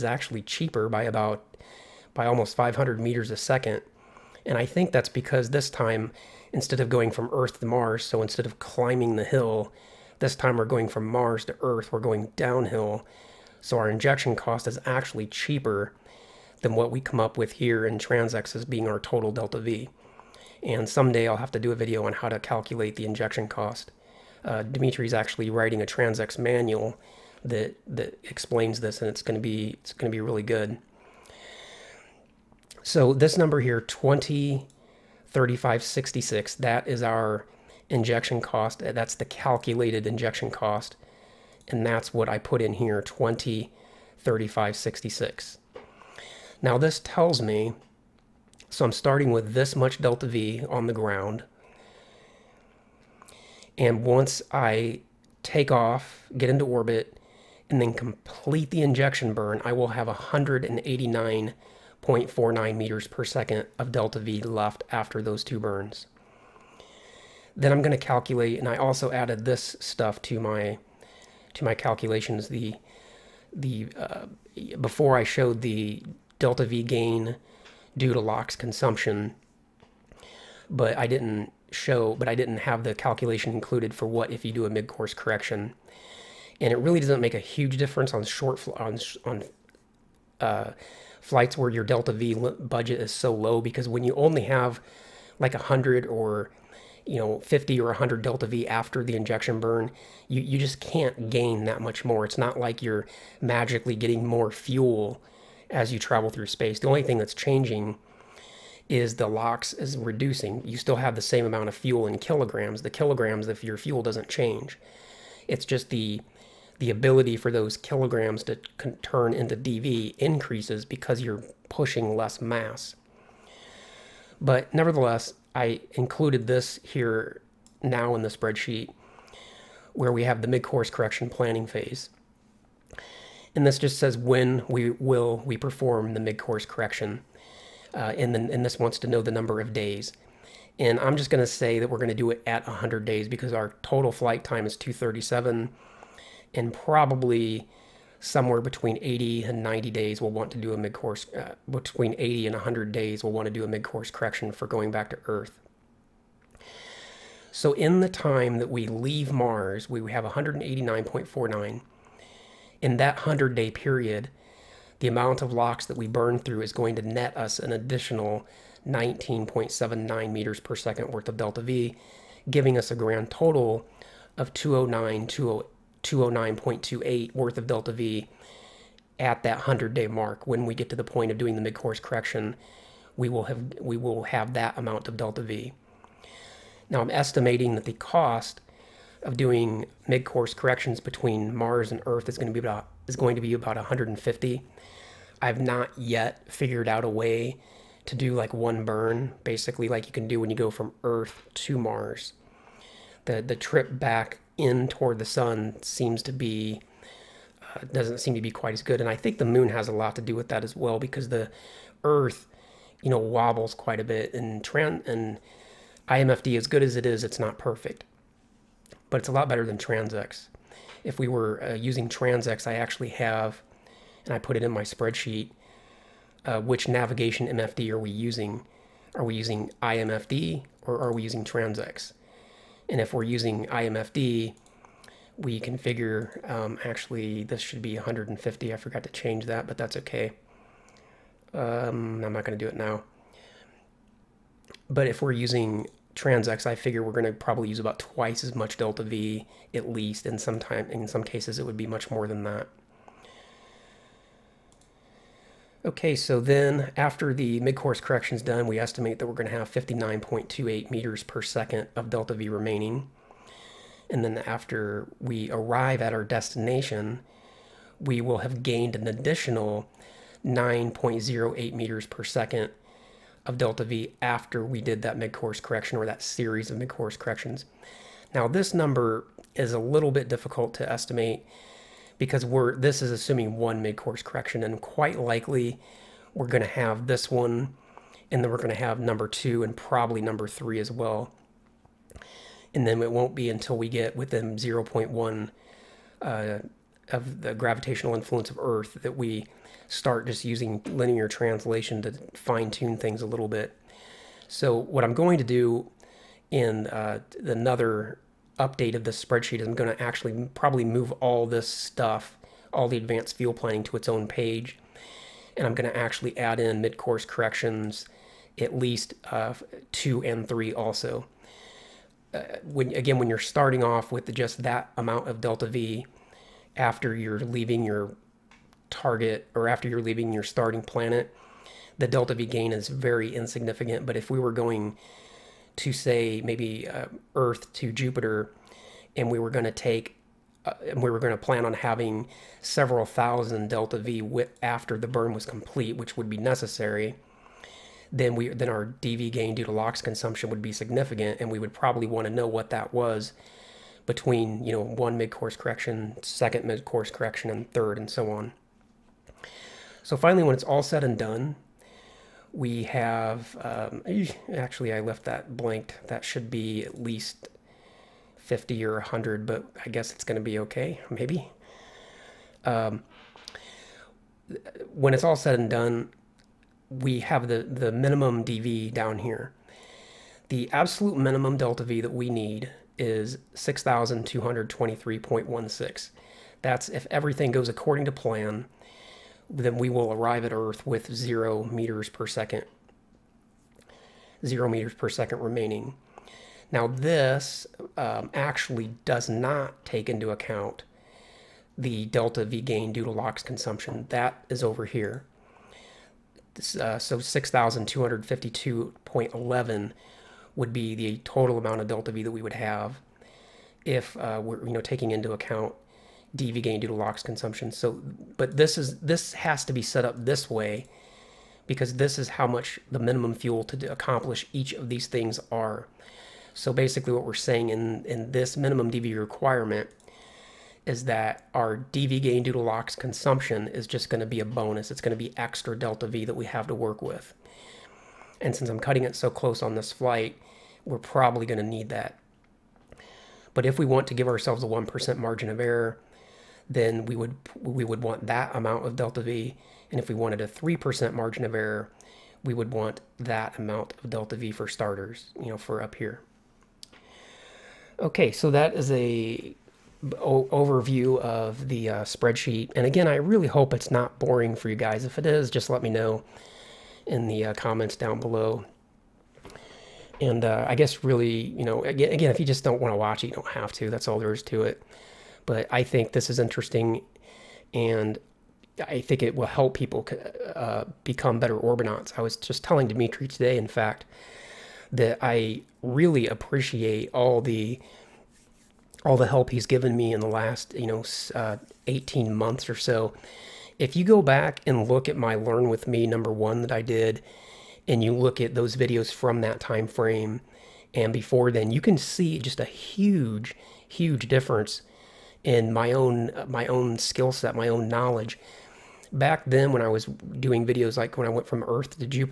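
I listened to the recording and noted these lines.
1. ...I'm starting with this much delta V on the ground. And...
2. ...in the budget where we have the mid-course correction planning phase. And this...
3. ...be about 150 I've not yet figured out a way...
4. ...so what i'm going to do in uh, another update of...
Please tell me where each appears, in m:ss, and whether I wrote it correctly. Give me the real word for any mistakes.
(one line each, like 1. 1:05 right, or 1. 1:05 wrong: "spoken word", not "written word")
1. 0:48 right
2. 2:08 wrong: "spreadsheet", not "budget"
3. 3:13 right
4. 5:04 right.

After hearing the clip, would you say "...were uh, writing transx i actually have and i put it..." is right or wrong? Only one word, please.
wrong.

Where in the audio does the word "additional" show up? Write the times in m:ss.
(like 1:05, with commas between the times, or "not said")
2:47, 4:29.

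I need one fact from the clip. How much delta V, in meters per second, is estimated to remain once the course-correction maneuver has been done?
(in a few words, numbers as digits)
59.28.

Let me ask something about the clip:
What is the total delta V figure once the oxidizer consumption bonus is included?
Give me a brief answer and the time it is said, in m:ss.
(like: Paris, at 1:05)
6,252.11, at 6:47.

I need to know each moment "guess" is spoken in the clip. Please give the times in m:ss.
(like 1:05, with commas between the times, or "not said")
6:09, 7:50.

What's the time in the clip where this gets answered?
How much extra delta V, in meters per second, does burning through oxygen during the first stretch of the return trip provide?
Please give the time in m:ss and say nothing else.
2:48.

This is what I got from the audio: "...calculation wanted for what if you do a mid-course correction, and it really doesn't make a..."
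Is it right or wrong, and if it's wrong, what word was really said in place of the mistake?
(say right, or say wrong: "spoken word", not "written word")
wrong: "included", not "wanted".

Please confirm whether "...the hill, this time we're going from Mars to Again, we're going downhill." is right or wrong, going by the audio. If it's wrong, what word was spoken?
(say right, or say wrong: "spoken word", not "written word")
wrong: "Earth", not "Again".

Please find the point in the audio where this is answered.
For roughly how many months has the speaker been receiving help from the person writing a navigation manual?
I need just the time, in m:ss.
8:11.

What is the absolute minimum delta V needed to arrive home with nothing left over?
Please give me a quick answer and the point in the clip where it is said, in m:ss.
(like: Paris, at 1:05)
6,223.16, at 6:23.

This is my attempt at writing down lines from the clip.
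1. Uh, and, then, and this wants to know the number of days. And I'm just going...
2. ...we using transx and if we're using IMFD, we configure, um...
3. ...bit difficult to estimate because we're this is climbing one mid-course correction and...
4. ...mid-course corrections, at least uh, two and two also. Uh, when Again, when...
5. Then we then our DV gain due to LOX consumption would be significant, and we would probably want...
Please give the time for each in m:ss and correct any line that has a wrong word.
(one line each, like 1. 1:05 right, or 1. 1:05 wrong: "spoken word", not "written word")
1. 2:17 right
2. 3:51 right
3. 4:40 wrong: "assuming", not "climbing"
4. 5:16 wrong: "three", not "two"
5. 5:48 right.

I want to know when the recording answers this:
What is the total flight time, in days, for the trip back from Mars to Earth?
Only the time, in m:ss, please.
2:24.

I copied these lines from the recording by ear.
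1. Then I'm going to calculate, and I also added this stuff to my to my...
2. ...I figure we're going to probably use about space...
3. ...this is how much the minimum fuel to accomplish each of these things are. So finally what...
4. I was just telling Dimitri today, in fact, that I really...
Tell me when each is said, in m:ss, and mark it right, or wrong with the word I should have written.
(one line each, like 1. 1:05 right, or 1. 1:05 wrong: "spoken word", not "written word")
1. 1:07 right
2. 4:06 wrong: "twice", not "space"
3. 7:01 wrong: "basically", not "finally"
4. 8:02 right.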